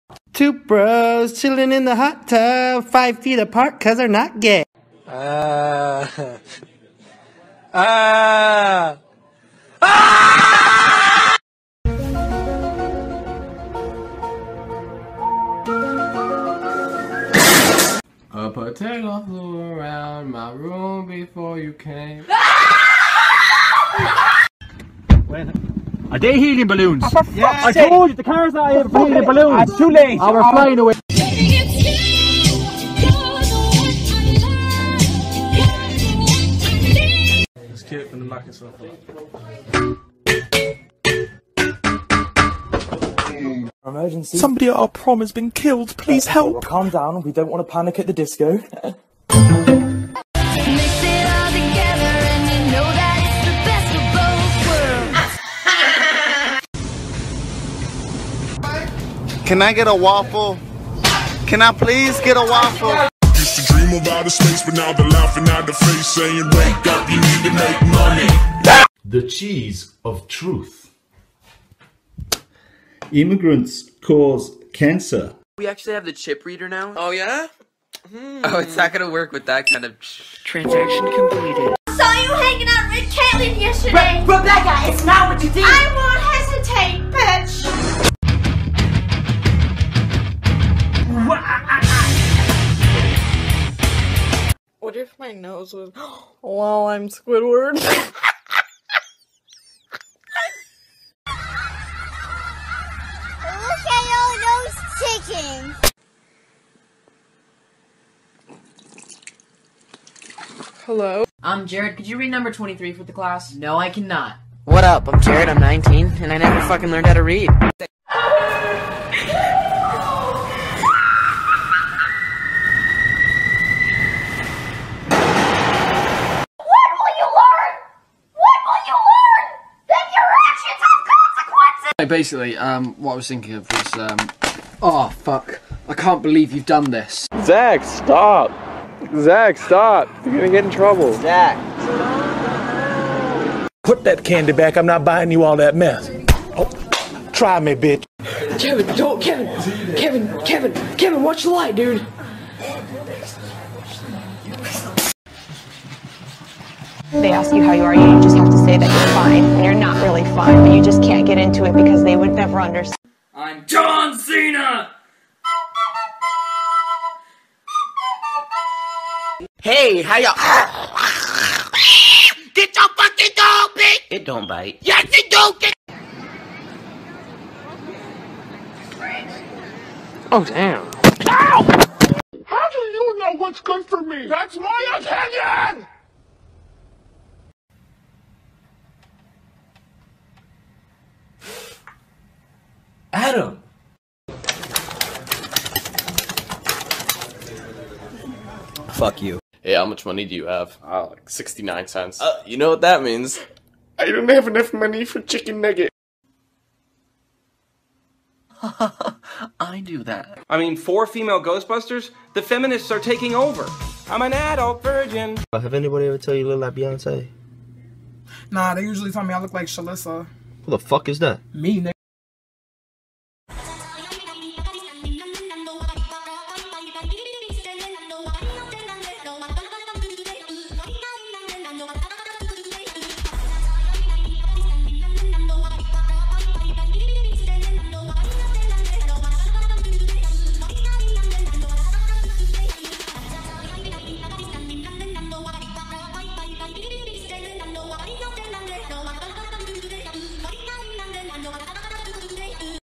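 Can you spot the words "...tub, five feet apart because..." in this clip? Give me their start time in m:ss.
0:02.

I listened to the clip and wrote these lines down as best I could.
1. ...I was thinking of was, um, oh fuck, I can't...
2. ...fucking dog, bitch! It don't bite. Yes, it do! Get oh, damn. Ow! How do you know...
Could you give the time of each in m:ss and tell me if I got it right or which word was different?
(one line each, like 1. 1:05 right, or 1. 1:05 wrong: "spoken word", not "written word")
1. 2:13 right
2. 2:52 right.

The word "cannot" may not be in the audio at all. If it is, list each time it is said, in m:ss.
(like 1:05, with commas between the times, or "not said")
1:53.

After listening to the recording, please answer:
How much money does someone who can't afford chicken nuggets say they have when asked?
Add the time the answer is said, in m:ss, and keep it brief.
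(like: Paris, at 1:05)
69 cents, at 3:21.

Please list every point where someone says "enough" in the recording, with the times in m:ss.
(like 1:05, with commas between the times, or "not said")
3:24.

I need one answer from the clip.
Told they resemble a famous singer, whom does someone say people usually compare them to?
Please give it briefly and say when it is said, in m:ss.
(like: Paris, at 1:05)
Shalissa, at 3:39.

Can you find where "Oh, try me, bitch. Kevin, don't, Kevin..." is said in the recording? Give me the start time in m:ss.
2:26.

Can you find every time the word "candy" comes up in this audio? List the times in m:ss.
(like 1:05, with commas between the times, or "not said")
2:24.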